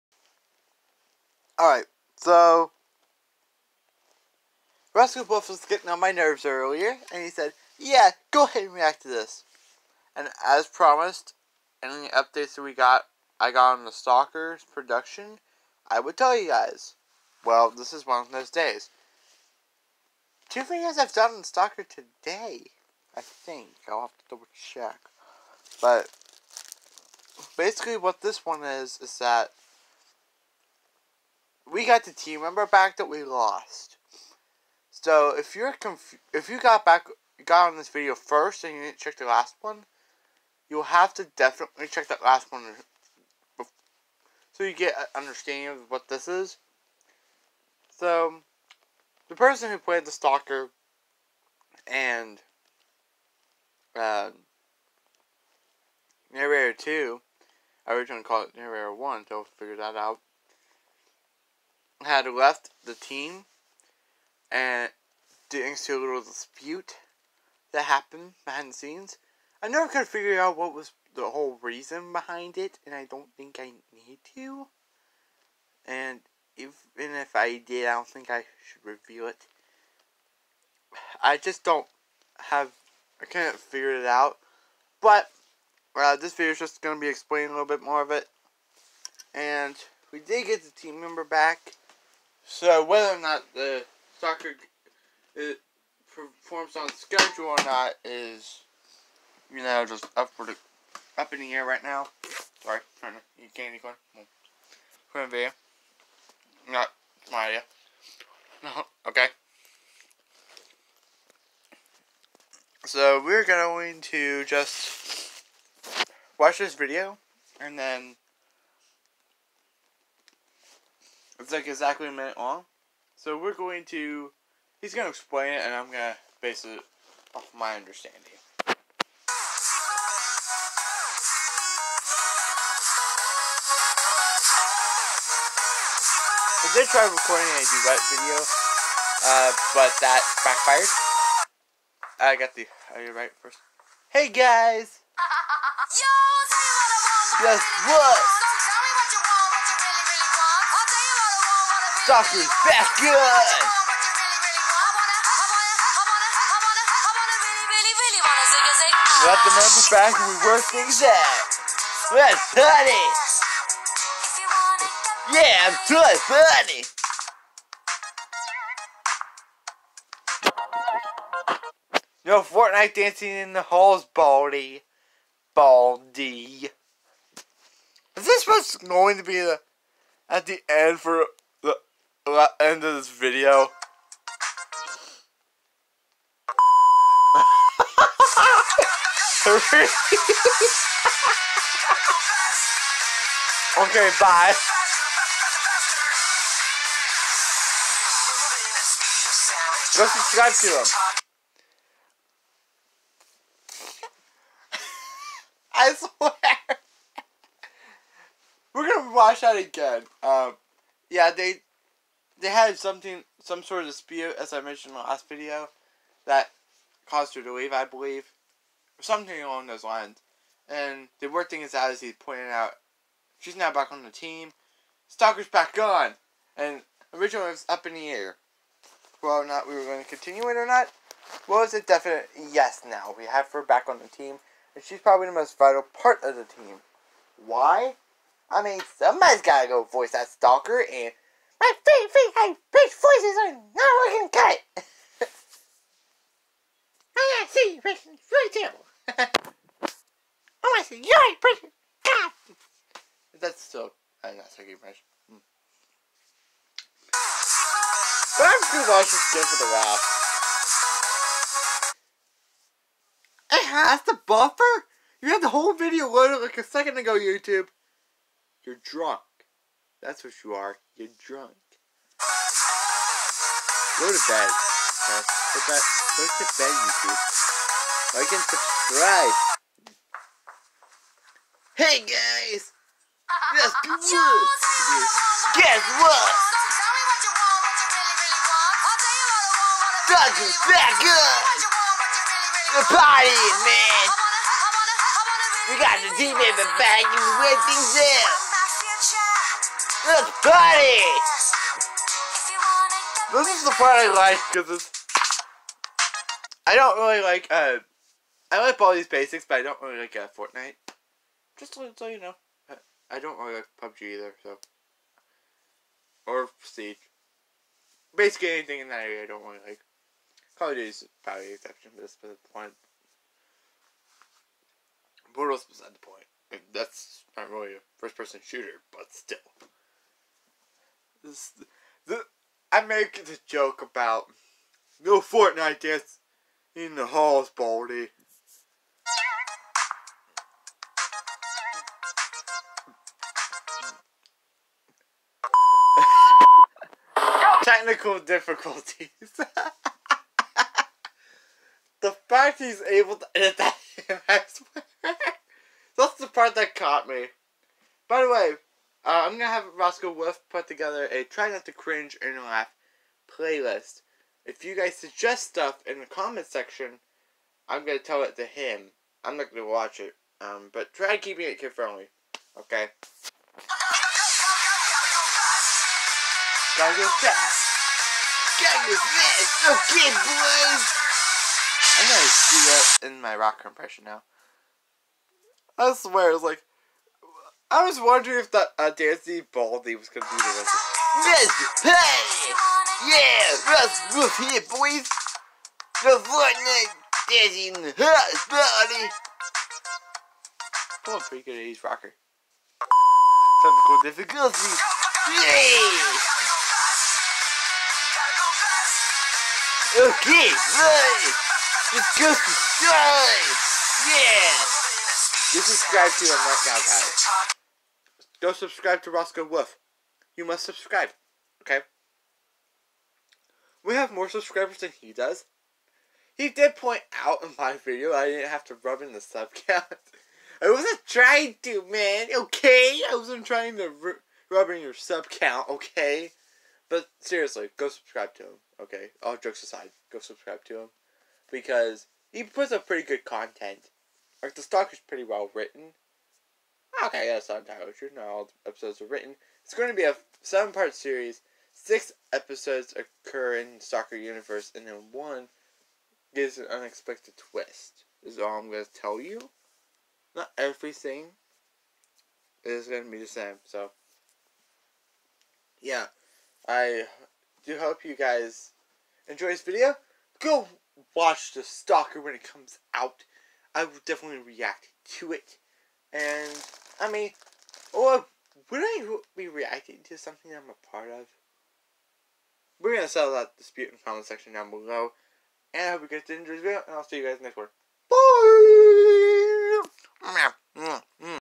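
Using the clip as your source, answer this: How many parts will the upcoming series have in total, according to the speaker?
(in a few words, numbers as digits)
7.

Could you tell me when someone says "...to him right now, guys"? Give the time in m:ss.
6:56.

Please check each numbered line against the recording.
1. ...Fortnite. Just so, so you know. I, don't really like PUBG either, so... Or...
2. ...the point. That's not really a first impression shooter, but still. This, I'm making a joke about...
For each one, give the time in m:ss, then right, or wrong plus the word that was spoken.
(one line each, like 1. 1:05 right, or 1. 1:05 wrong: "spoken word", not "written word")
1. 5:10 right
2. 5:25 wrong: "person", not "impression".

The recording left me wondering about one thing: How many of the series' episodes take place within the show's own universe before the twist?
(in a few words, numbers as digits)
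6.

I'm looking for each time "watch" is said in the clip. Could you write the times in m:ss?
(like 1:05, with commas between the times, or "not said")
1:56, 3:29, 6:09, 7:51.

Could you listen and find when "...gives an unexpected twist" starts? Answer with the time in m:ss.
7:36.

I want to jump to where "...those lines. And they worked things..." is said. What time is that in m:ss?
3:39.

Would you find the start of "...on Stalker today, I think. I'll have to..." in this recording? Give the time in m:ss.
0:21.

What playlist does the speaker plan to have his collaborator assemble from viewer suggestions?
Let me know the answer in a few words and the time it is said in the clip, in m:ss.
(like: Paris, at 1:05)
Try not to cringe and laugh, at 6:01.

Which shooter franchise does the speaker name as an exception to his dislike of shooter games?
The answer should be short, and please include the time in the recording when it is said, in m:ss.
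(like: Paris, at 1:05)
Call of Duty, at 5:20.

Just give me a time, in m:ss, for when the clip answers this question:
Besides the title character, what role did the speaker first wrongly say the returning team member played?
0:58.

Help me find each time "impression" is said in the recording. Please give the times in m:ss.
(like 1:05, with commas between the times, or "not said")
4:14, 6:23.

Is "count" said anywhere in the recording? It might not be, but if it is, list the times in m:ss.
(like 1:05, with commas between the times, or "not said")
7:09, 7:15.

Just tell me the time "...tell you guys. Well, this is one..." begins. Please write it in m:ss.
0:16.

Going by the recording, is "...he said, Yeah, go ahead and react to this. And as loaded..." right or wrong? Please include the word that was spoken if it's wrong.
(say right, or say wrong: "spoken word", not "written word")
wrong: "promised", not "loaded".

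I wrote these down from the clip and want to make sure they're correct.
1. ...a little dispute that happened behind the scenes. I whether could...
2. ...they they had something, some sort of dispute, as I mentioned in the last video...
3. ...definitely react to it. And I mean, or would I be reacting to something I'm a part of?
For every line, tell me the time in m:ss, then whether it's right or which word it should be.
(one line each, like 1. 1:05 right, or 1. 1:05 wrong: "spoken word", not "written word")
1. 1:05 wrong: "never", not "whether"
2. 3:31 right
3. 7:54 right.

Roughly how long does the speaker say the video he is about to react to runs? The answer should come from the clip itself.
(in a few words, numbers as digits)
A minute.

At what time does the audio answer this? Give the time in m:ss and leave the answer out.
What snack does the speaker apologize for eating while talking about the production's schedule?
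1:43.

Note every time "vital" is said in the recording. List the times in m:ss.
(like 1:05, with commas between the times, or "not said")
3:55.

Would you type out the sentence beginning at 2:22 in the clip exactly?
I got the Are you right first.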